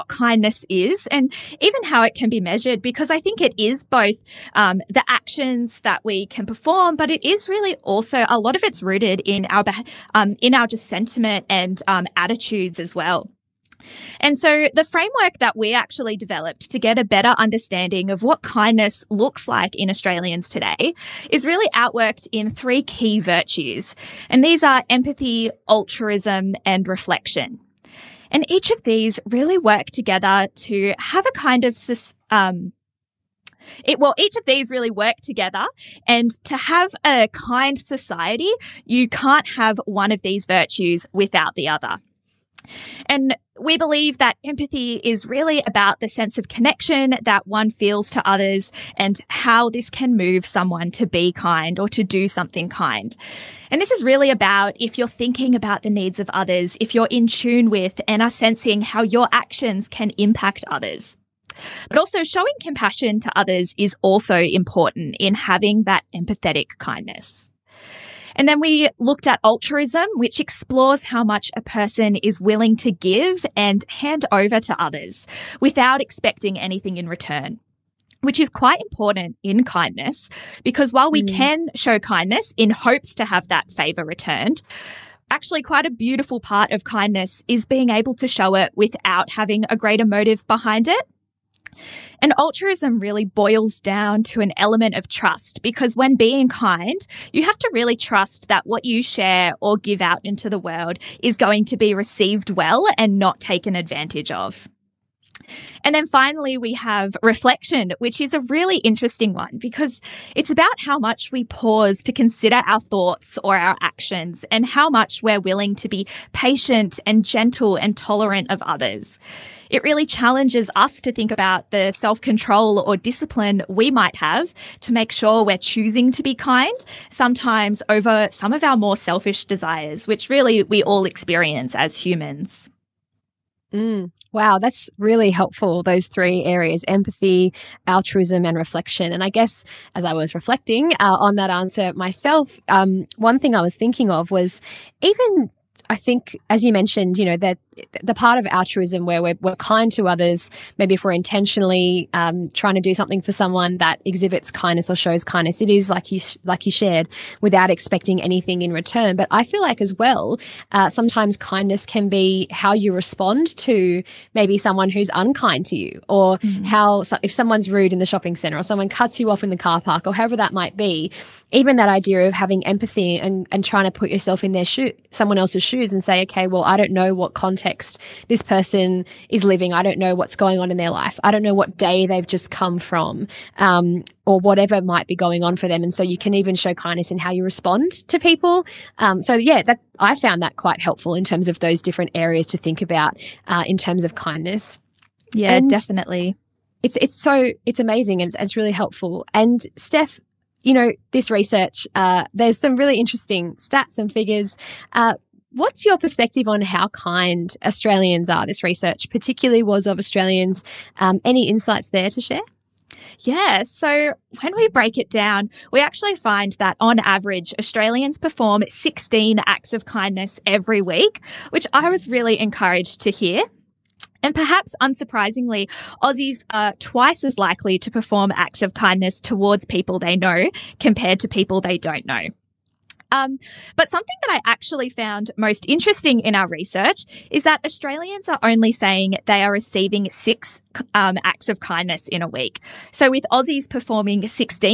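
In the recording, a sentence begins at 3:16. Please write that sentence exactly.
It's, it's so it's amazing and it's, it's really helpful.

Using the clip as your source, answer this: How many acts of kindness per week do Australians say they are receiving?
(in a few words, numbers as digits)
6.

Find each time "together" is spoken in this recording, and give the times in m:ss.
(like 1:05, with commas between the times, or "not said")
0:29, 0:35.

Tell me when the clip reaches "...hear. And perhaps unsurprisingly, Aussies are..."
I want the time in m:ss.
3:43.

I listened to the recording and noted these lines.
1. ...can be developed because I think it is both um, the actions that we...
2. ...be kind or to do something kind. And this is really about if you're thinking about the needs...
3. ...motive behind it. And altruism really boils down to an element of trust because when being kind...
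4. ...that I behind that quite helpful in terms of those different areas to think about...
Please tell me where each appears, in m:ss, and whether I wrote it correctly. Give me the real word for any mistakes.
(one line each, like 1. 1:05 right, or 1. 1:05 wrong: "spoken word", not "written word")
1. 0:02 wrong: "measured", not "developed"
2. 0:51 right
3. 1:30 right
4. 3:09 wrong: "found", not "behind".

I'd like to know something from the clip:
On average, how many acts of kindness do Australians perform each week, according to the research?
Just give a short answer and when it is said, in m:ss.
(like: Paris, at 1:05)
16, at 3:38.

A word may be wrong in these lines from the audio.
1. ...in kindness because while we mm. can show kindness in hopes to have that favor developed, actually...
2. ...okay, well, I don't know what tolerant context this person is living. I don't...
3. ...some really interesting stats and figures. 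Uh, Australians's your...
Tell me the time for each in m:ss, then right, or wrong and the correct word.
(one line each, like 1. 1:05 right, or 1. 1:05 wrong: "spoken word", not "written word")
1. 1:19 wrong: "returned", not "developed"
2. 2:56 wrong: "content", not "tolerant"
3. 3:22 wrong: "What", not "Australians".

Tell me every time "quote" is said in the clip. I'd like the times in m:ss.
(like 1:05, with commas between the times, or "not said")
not said.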